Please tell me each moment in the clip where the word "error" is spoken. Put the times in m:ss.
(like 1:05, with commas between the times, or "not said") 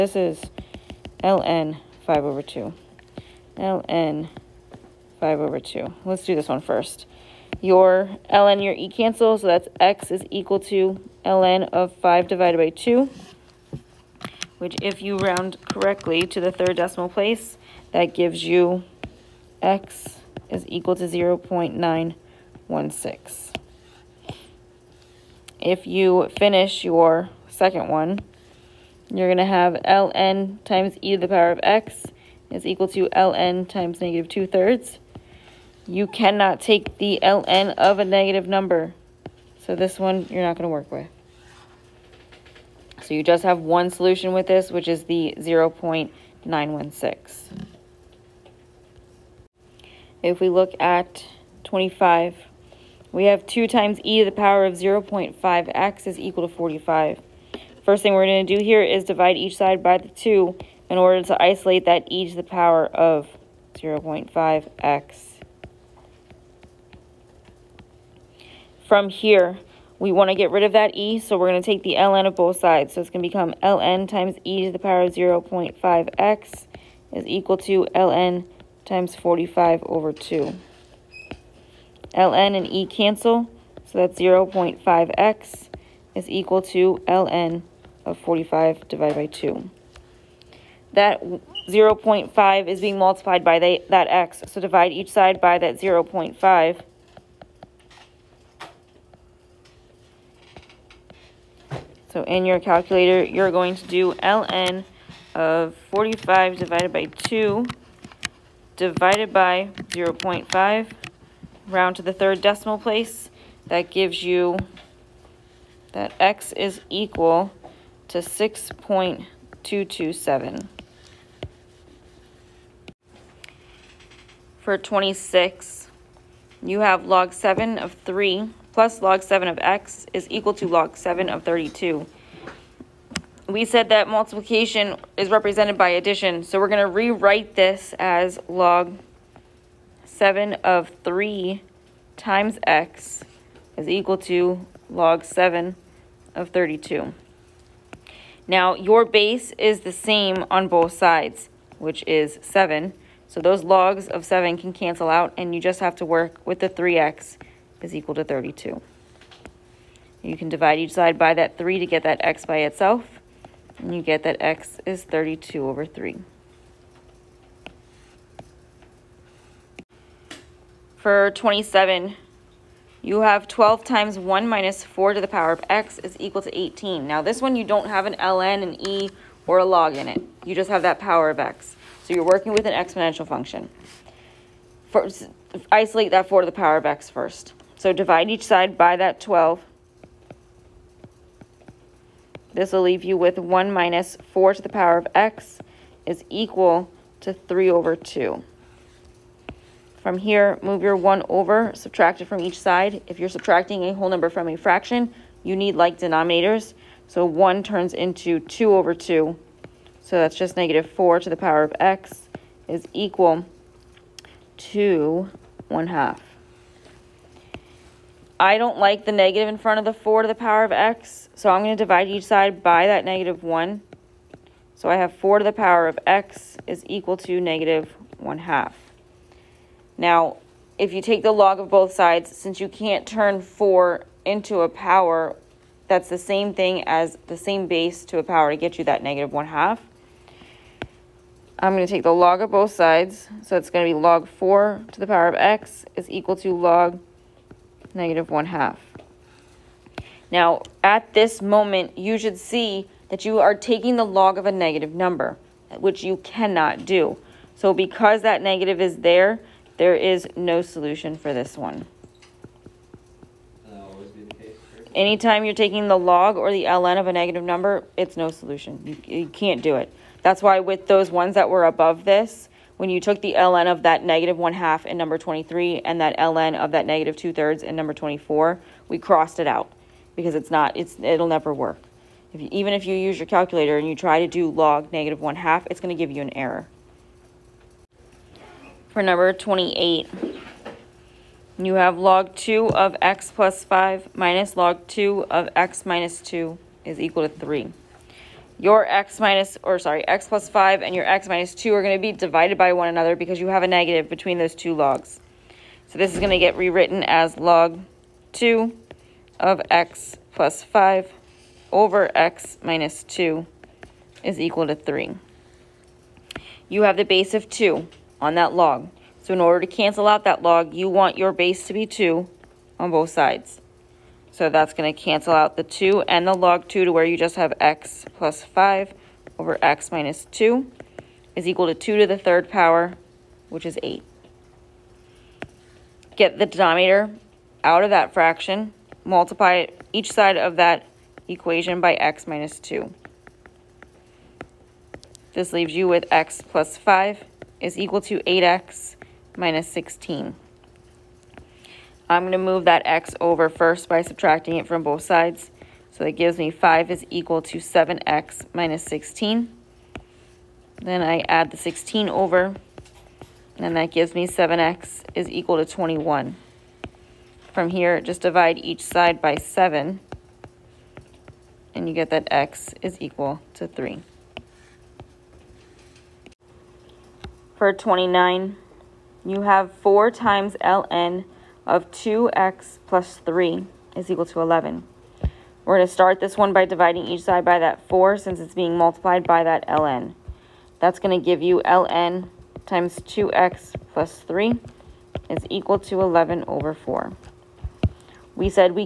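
4:46.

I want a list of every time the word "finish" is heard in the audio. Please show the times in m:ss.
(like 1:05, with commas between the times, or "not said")
0:26.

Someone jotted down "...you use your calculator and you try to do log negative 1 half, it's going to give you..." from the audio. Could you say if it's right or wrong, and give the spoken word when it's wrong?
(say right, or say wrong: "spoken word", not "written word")
right.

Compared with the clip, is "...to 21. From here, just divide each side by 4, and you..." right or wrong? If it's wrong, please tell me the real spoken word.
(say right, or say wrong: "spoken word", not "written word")
wrong: "7", not "4".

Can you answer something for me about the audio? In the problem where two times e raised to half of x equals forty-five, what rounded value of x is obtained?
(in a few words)
6.227.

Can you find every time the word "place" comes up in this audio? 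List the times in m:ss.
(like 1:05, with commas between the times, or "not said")
0:17, 1:52.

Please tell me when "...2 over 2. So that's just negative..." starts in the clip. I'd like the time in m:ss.
3:28.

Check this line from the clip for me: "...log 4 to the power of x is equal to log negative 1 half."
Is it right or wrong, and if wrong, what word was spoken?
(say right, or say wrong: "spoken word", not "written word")
right.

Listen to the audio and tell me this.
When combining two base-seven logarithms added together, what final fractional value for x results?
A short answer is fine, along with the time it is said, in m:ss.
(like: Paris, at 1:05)
32/3, at 2:45.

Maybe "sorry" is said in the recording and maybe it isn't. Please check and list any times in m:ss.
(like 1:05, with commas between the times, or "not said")
4:59.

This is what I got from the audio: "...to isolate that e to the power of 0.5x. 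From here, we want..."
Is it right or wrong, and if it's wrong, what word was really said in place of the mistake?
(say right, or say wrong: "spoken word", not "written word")
right.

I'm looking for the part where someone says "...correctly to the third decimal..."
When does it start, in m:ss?
0:15.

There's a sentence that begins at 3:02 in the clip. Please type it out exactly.
So you're working with an exponential function.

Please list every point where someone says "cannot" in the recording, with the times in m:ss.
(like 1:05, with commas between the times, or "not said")
0:36, 4:16.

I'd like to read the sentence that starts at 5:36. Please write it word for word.
Get the denominator out of that fraction multiply each side of that equation by x minus 2.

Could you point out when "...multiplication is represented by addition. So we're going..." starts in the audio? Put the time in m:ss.
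2:14.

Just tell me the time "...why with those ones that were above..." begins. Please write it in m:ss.
4:30.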